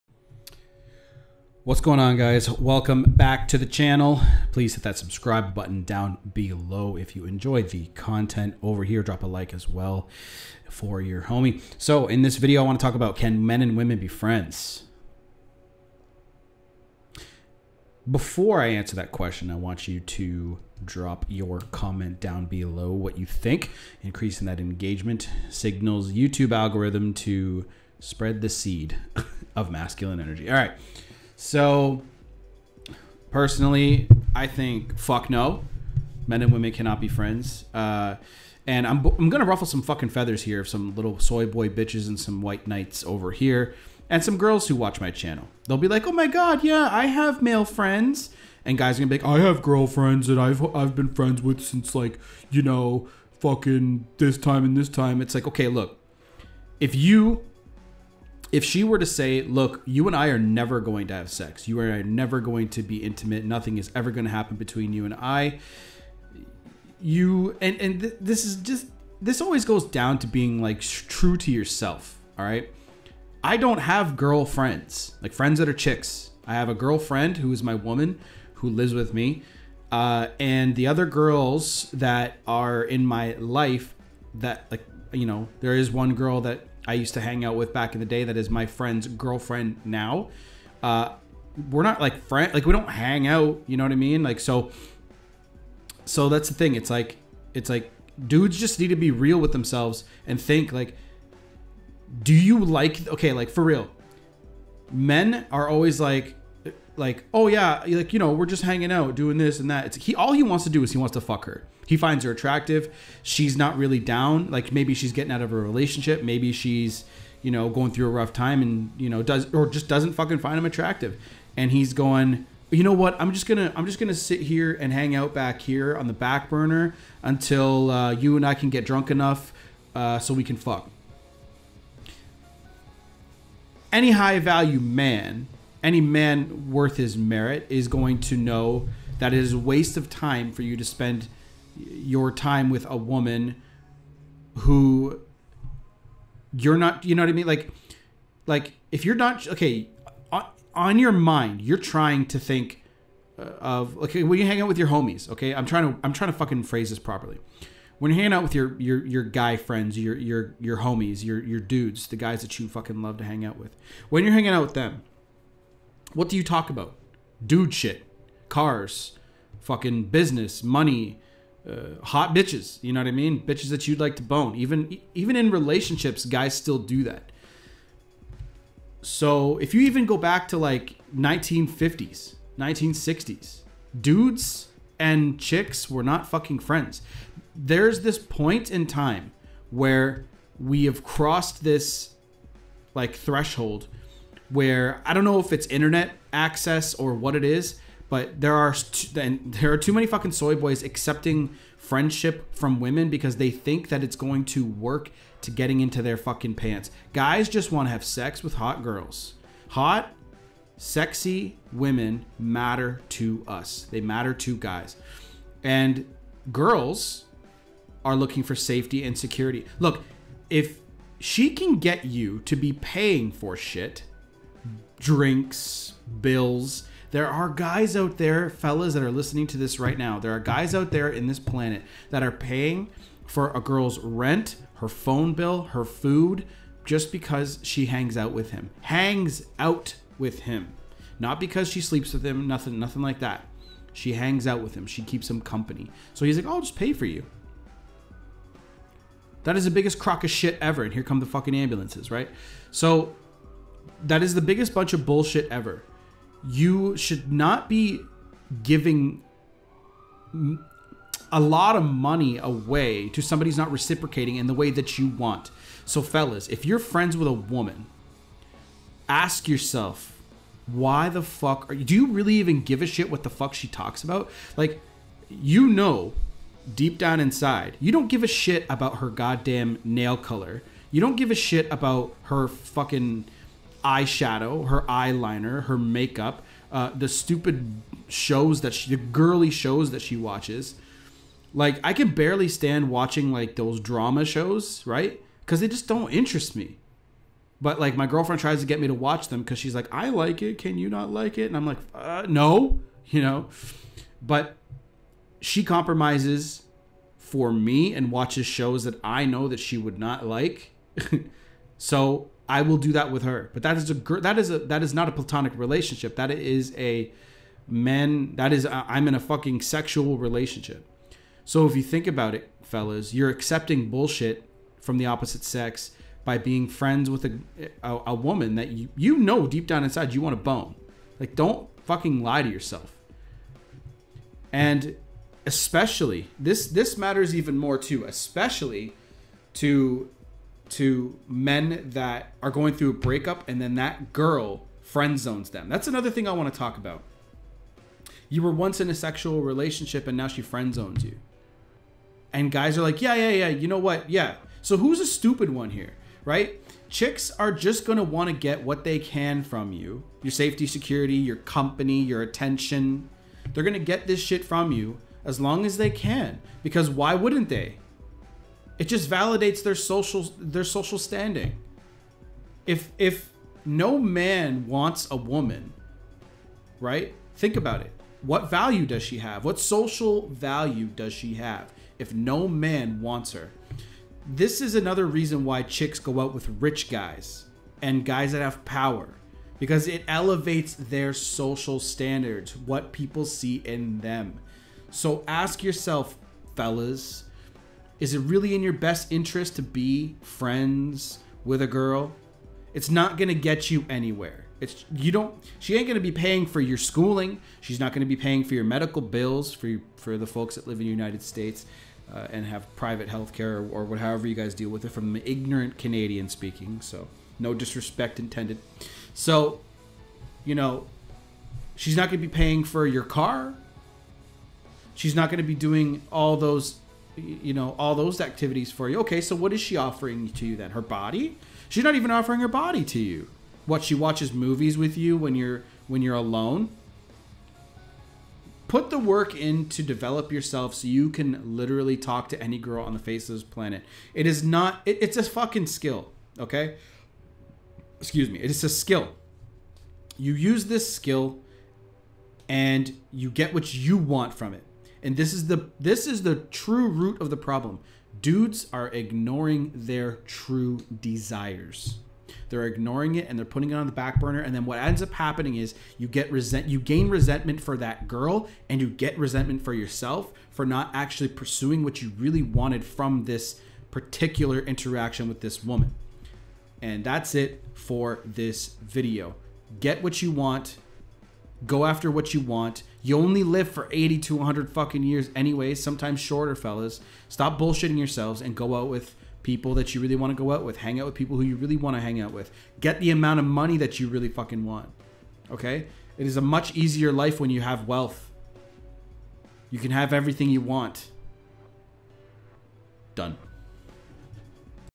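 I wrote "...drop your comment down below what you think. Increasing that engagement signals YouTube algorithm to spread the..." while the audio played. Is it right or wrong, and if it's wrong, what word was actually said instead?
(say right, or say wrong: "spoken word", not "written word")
right.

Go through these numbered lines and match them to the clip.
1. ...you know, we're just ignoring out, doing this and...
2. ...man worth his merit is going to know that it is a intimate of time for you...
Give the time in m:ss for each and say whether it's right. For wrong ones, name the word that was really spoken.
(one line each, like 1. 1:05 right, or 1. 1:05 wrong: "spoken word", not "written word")
1. 1:48 wrong: "hanging", not "ignoring"
2. 2:16 wrong: "waste", not "intimate".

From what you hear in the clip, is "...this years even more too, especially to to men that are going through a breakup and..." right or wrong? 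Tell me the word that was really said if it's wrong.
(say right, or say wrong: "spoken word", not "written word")
wrong: "matters", not "years".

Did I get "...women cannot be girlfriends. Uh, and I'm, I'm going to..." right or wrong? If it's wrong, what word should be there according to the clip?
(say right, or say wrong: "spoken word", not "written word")
wrong: "friends", not "girlfriends".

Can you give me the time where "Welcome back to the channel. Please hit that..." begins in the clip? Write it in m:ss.
0:02.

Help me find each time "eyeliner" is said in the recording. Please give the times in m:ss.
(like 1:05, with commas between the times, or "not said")
4:44.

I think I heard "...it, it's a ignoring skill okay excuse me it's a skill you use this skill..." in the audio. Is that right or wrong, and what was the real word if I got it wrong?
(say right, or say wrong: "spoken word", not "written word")
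wrong: "fucking", not "ignoring".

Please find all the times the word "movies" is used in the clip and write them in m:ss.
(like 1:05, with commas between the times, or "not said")
7:14.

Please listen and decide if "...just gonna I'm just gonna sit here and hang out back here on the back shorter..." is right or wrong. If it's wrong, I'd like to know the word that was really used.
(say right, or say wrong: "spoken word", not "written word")
wrong: "burner", not "shorter".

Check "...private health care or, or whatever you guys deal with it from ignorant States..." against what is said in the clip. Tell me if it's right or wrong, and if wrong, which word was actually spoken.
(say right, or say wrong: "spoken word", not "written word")
wrong: "Canadian", not "States".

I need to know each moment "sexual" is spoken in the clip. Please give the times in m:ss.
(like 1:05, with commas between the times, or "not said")
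5:19, 5:48.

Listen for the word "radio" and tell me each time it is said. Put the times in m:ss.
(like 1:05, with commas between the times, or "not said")
not said.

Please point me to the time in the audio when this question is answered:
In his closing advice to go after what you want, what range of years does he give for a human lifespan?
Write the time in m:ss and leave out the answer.
8:03.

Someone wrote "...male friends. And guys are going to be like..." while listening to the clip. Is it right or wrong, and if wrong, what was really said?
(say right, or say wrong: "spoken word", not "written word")
right.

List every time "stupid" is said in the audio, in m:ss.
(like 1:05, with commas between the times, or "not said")
4:47, 5:55.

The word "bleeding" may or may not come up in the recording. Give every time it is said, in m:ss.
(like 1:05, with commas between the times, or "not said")
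not said.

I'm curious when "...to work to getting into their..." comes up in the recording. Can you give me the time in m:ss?
3:24.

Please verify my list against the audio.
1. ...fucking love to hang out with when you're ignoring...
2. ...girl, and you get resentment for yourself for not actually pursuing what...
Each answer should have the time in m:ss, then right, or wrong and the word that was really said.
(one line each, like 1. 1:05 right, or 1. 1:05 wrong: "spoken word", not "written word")
1. 2:42 wrong: "hanging", not "ignoring"
2. 7:48 right.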